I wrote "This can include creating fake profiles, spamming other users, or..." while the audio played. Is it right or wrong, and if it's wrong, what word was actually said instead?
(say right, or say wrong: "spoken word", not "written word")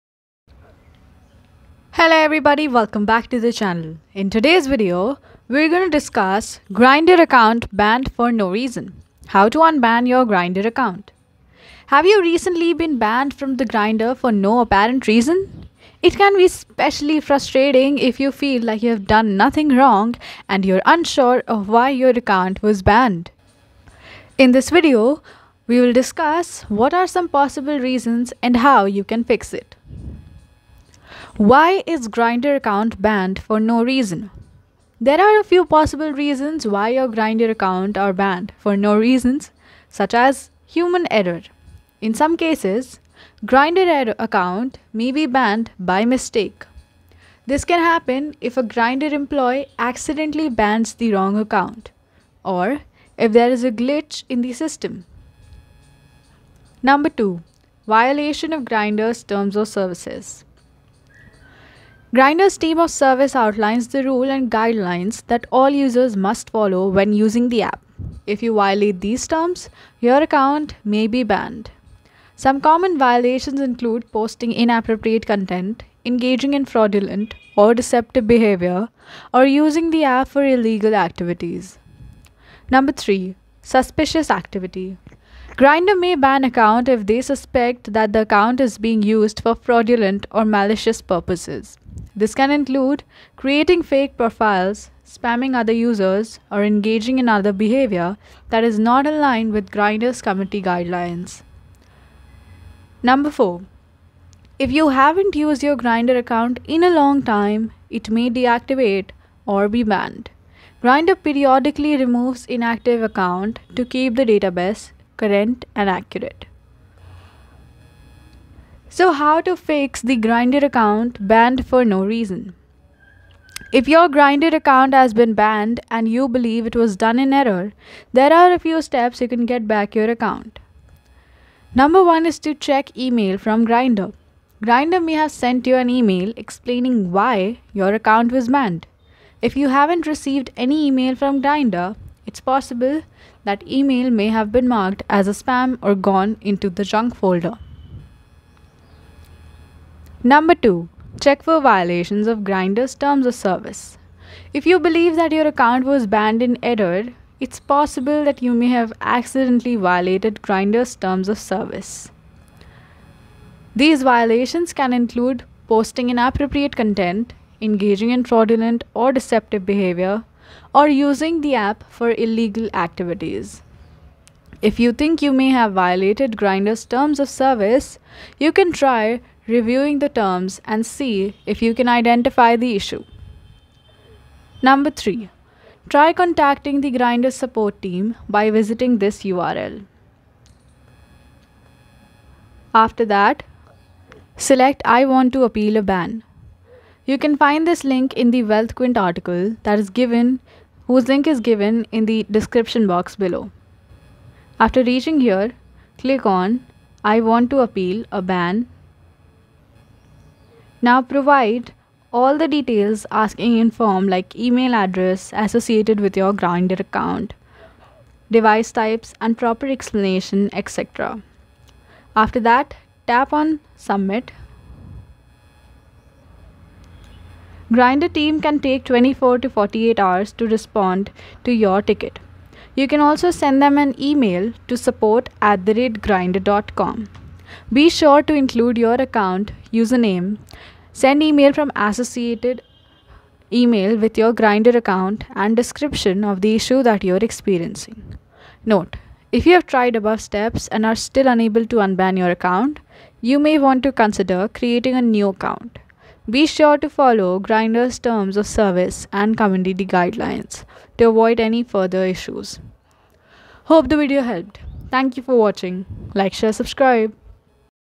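right.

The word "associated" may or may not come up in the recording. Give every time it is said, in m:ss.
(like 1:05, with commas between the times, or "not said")
3:35, 4:01.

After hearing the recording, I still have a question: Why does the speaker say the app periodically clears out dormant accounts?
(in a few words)
keep the database current.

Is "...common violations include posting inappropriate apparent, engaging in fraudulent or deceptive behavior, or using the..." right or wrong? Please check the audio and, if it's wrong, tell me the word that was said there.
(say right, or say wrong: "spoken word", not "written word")
wrong: "content", not "apparent".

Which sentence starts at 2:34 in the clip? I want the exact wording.
If you believe that your account was banned in error, it's possible that you may have accidentally violated Grindr's terms of service.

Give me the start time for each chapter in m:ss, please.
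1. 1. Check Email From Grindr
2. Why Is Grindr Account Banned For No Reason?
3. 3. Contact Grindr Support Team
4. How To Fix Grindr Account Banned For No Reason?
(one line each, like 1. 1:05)
1. 2:11
2. 0:30
3. 3:03
4. 1:58.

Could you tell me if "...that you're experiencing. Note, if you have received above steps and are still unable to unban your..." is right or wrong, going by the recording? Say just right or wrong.
wrong.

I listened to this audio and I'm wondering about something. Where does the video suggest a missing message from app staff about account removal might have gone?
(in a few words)
junk folder.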